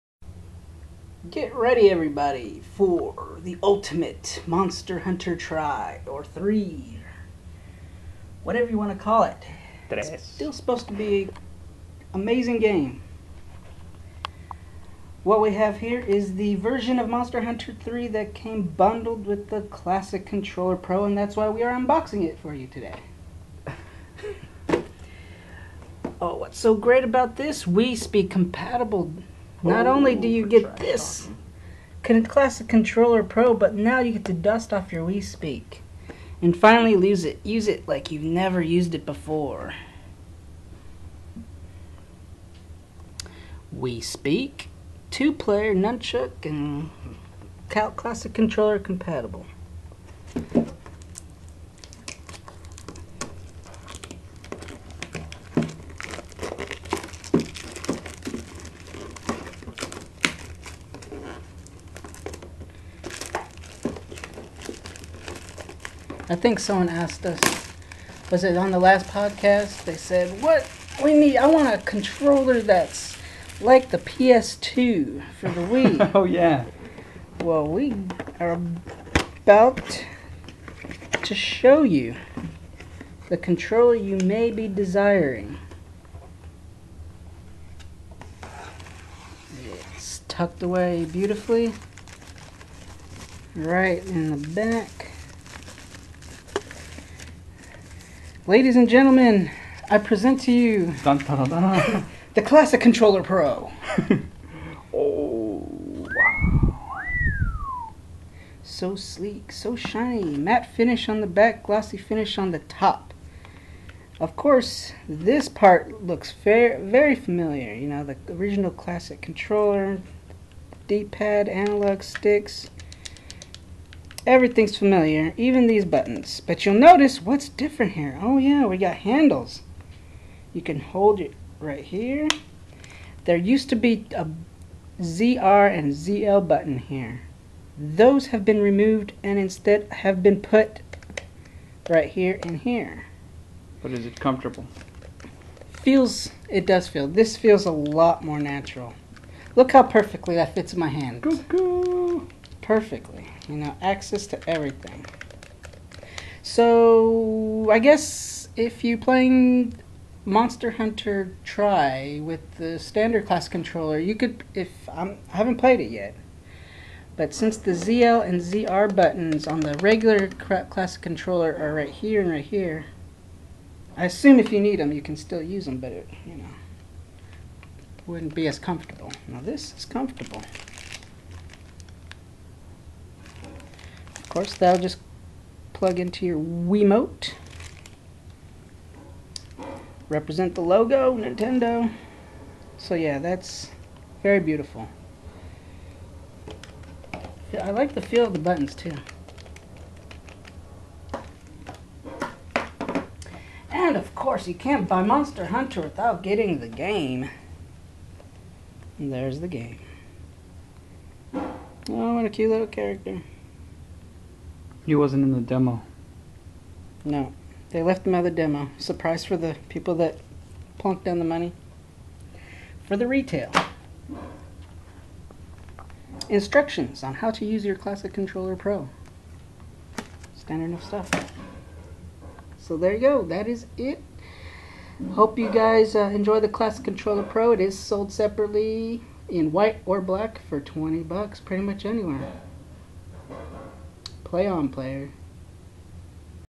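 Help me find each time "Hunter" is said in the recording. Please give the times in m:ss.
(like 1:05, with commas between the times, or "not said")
0:04, 0:17, 2:40, 3:25.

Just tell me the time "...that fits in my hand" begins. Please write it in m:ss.
2:30.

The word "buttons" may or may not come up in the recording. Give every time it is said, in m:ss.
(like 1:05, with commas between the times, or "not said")
2:05, 2:16, 2:48, 3:18.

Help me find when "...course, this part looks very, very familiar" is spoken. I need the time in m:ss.
1:54.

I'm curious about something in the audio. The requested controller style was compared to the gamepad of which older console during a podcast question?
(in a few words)
PS2.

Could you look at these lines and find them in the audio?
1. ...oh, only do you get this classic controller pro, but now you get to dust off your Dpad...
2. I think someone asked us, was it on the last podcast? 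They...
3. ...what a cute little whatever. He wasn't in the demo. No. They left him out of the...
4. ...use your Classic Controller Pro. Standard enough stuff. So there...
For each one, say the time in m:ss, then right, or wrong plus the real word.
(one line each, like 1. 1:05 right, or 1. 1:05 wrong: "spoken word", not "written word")
1. 0:29 wrong: "Wii", not "Dpad"
2. 1:06 right
3. 3:32 wrong: "character", not "whatever"
4. 3:47 right.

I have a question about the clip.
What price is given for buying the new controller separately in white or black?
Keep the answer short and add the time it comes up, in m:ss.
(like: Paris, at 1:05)
$20, at 4:00.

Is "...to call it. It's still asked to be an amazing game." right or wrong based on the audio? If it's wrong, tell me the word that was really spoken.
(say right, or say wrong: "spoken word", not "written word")
wrong: "supposed", not "asked".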